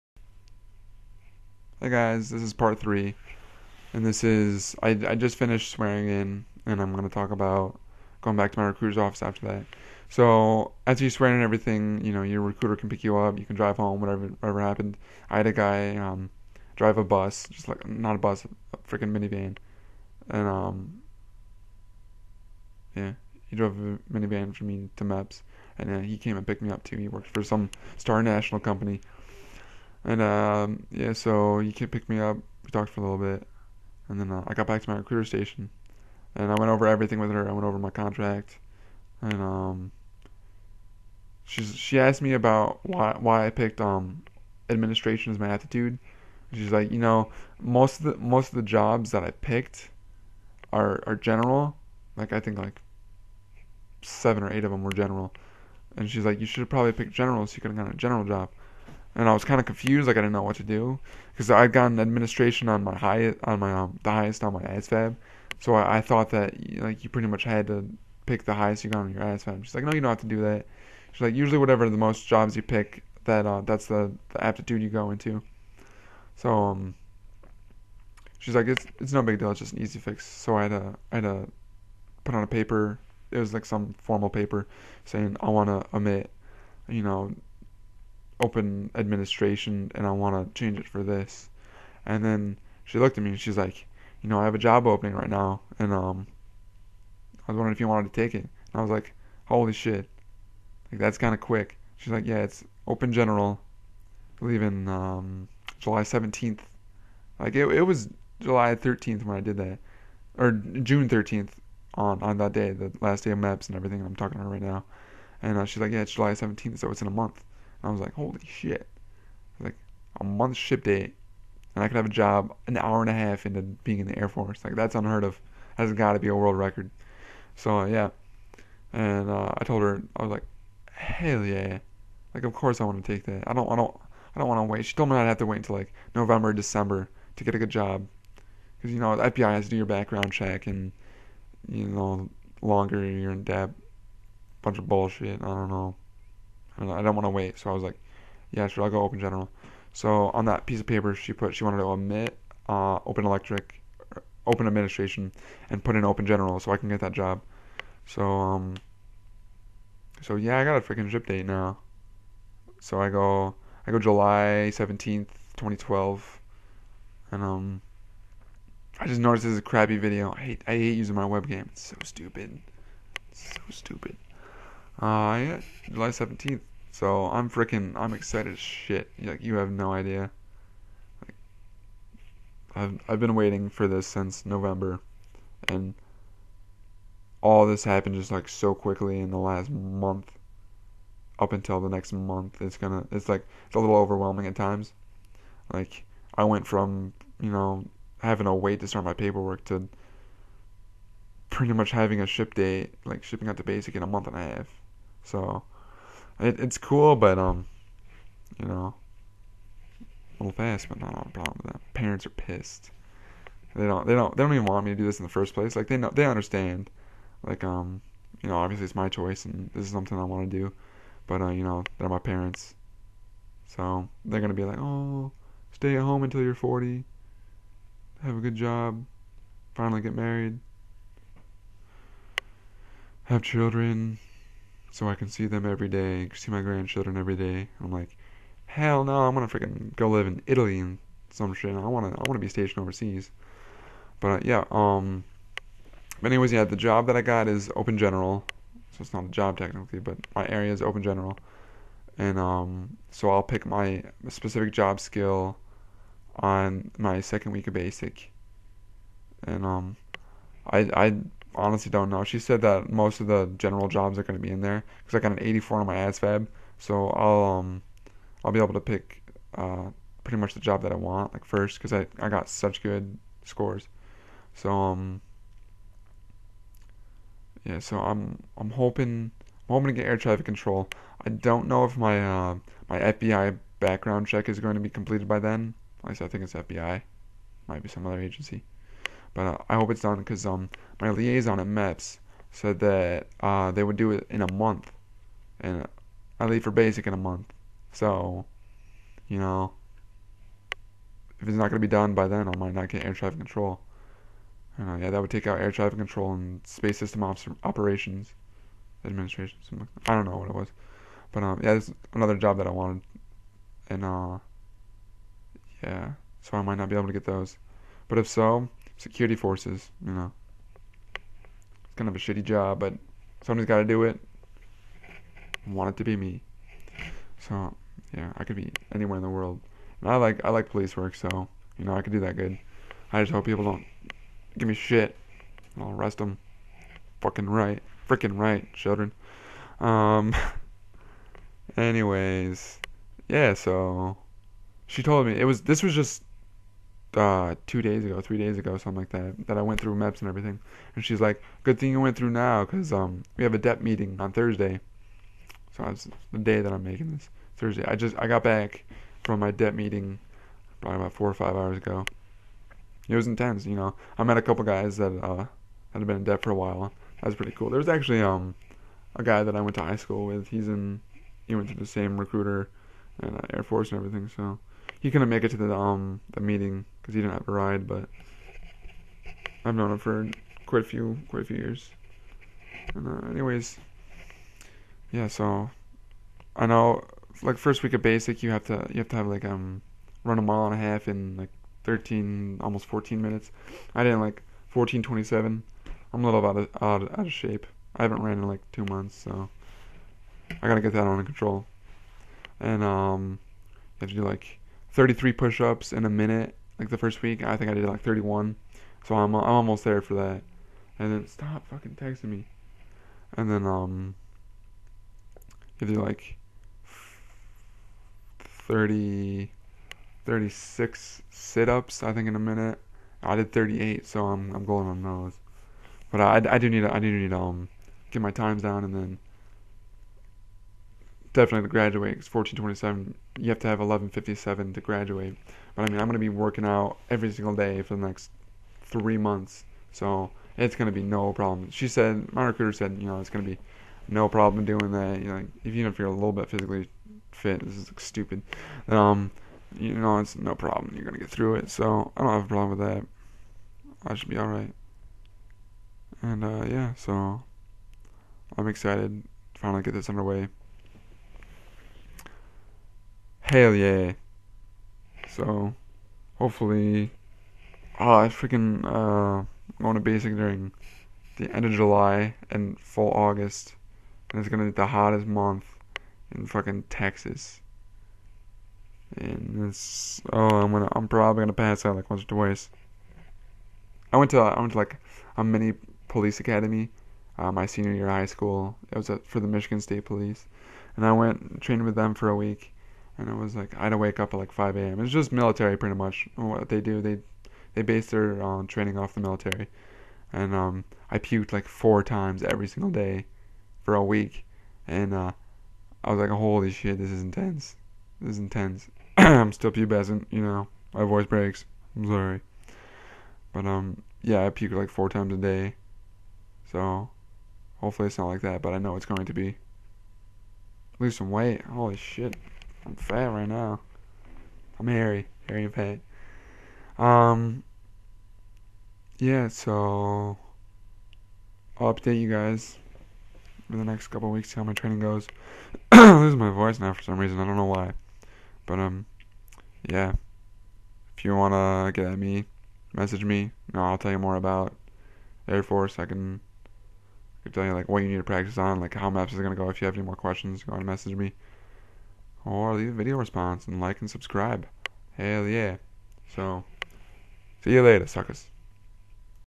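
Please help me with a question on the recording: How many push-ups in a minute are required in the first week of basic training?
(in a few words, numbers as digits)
33.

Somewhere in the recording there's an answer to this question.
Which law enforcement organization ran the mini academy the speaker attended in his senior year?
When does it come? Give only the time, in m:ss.
8:09.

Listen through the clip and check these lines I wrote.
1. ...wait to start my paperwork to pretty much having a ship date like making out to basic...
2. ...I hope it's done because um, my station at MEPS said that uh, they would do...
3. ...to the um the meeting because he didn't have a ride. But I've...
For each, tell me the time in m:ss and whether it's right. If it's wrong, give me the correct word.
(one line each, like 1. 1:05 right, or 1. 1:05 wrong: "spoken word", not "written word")
1. 3:18 wrong: "shipping", not "making"
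2. 4:49 wrong: "liaison", not "station"
3. 6:15 right.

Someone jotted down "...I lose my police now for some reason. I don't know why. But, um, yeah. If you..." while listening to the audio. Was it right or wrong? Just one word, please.
wrong.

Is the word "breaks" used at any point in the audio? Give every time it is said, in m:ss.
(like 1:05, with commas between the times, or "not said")
8:31.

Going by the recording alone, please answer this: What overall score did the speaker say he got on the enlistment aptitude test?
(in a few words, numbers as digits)
84.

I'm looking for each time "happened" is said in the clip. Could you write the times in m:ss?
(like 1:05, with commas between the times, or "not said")
0:14, 3:07.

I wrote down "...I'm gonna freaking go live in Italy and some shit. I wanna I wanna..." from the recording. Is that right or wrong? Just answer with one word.
right.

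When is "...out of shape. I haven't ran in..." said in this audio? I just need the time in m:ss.
6:37.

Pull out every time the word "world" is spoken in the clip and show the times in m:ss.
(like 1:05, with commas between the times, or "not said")
2:06, 5:29.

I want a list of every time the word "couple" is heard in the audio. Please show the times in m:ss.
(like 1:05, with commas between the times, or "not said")
6:04, 8:54.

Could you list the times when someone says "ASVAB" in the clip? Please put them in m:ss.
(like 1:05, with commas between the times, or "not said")
1:04, 1:09, 4:25.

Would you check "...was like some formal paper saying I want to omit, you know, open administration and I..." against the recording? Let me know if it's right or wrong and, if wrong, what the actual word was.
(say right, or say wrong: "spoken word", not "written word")
right.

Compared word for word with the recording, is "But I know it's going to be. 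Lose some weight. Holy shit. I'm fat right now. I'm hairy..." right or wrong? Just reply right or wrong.
right.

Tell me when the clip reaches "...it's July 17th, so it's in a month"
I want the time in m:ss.
1:56.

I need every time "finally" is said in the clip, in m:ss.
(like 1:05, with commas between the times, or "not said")
3:49, 7:39.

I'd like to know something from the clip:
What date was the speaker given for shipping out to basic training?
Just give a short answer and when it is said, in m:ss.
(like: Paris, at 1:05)
July 17th, 2012, at 2:43.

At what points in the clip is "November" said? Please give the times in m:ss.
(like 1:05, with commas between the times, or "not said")
2:16, 3:04.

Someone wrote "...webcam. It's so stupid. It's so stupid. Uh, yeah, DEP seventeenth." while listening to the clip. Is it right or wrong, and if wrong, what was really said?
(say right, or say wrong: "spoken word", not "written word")
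wrong: "July", not "DEP".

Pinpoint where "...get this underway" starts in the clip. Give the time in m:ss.
7:39.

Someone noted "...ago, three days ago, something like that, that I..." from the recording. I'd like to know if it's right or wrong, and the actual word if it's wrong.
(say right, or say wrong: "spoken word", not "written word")
right.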